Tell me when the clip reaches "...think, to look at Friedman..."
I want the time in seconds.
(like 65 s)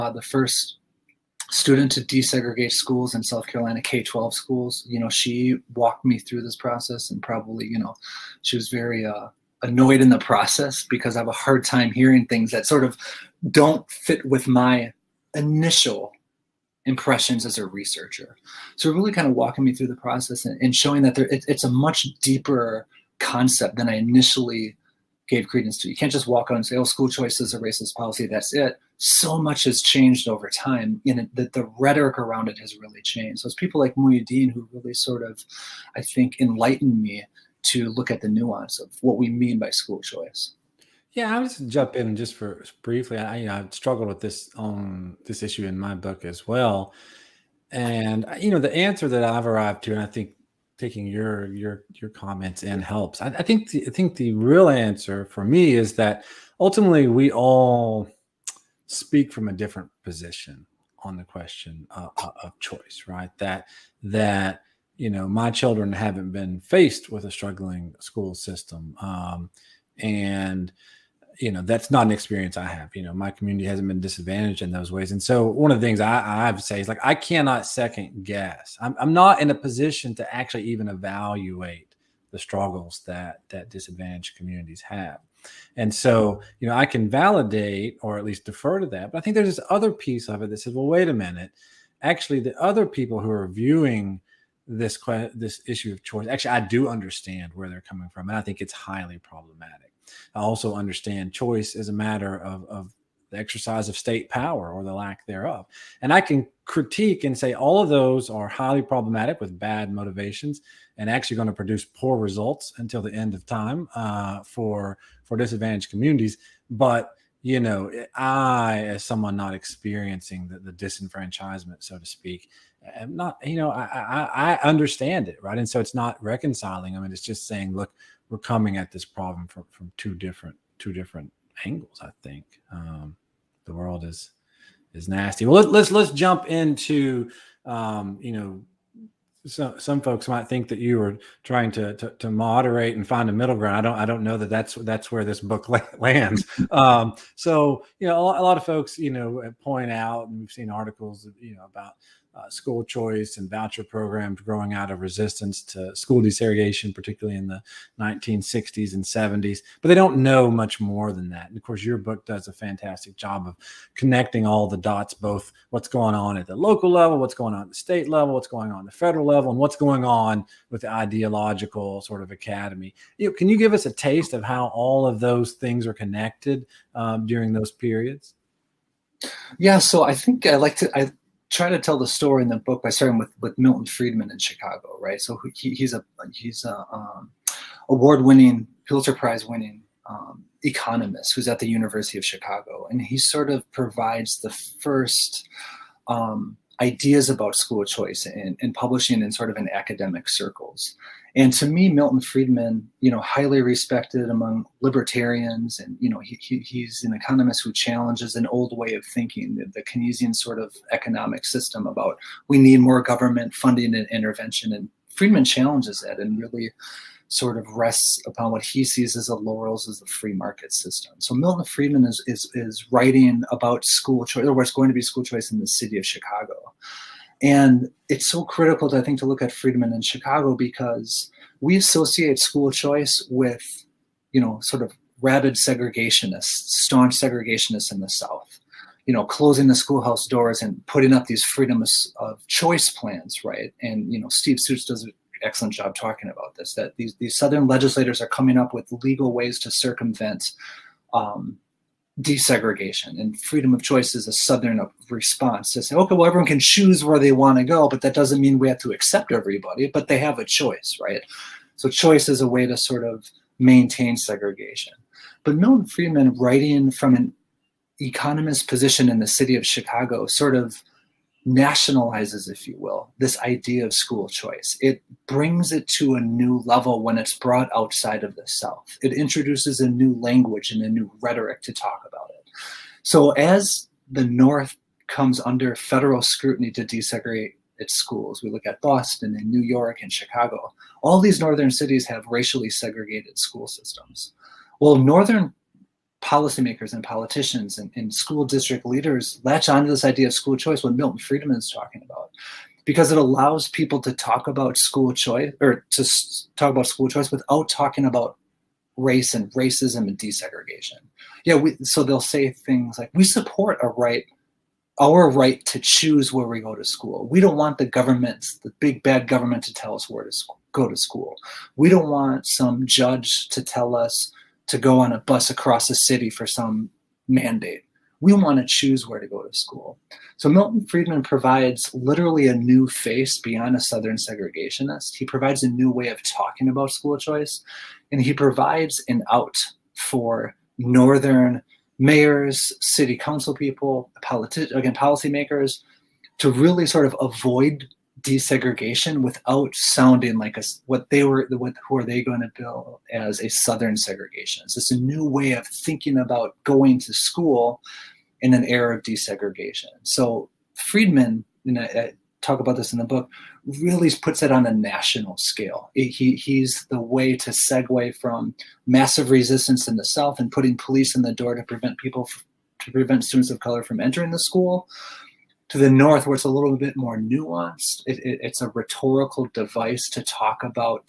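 229 s.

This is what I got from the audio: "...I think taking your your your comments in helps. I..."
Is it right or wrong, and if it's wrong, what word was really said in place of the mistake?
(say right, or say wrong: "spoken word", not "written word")
right.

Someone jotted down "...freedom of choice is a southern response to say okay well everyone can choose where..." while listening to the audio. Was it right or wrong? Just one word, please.
right.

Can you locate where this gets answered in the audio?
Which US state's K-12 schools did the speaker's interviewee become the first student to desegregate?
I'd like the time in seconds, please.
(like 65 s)
3 s.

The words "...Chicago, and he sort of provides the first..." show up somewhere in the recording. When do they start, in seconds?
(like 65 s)
192 s.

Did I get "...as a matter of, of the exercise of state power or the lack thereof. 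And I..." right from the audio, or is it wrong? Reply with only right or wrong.
right.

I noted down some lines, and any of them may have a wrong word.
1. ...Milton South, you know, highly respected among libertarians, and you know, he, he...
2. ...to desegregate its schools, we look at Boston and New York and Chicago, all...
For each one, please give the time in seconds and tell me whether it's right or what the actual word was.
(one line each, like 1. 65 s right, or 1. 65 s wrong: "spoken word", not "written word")
1. 201 s wrong: "Friedman", not "South"
2. 286 s right.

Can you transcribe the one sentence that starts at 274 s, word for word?
It brings it to a new level when it's brought outside of the South.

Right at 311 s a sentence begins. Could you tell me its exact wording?
Yeah, we, so they'll say things like, "We support a right." Our right to choose where we go to school.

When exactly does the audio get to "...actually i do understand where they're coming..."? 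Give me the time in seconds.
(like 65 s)
96 s.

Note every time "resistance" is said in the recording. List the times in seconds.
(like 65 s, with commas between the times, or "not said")
155 s, 369 s.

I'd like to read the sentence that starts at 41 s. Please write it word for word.
Yeah, I'll just jump in and just for briefly.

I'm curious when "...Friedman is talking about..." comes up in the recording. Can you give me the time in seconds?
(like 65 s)
301 s.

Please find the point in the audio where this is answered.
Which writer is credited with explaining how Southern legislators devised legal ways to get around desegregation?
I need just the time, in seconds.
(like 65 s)
244 s.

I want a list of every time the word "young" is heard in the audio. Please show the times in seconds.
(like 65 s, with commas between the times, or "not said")
not said.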